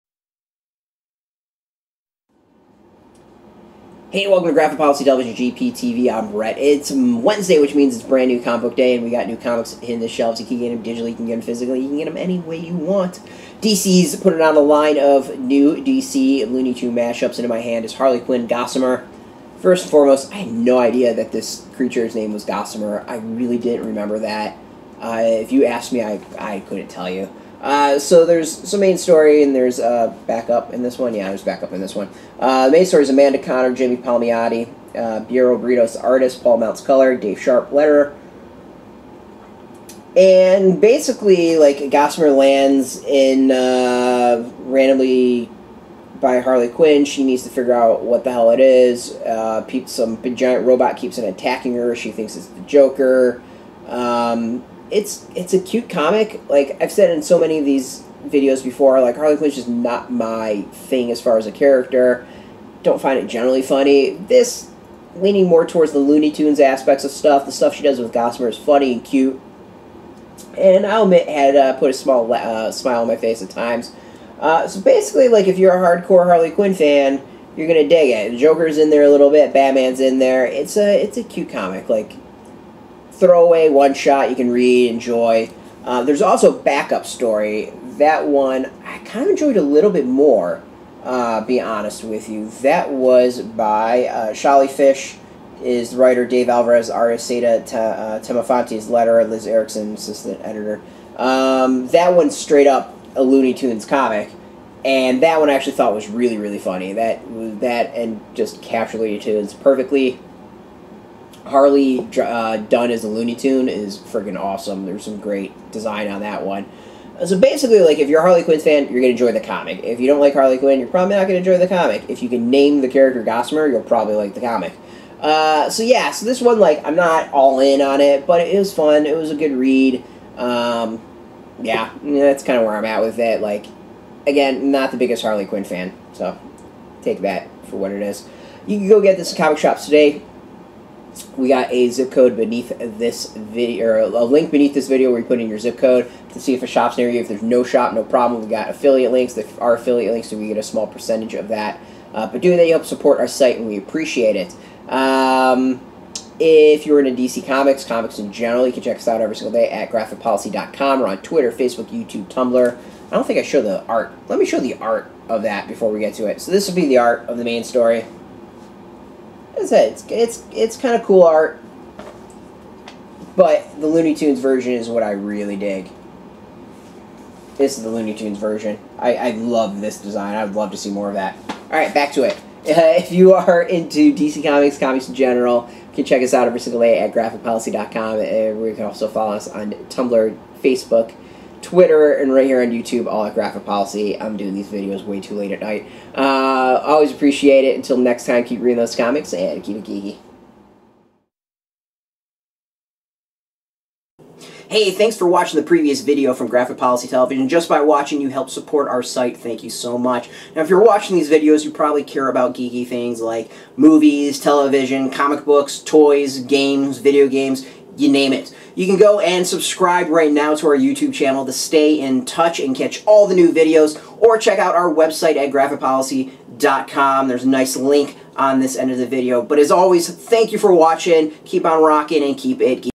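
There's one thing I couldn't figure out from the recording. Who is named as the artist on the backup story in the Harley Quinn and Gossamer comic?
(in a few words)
Dave Alvarez.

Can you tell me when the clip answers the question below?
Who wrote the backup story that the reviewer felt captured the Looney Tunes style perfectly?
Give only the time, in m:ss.
1:34.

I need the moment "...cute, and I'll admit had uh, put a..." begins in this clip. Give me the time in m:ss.
1:09.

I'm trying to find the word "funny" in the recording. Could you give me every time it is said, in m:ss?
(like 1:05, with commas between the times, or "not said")
1:03, 1:08, 1:46.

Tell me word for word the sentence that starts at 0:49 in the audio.
Uh, some giant robot keeps on attacking her.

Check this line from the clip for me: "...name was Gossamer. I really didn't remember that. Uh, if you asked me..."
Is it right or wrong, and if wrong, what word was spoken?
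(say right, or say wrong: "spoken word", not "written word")
right.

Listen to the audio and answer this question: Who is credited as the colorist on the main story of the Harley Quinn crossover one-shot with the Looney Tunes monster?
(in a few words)
Paul Mounts.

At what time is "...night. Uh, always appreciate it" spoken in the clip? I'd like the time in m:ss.
3:15.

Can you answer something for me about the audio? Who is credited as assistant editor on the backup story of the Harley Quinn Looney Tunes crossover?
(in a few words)
Liz Erickson.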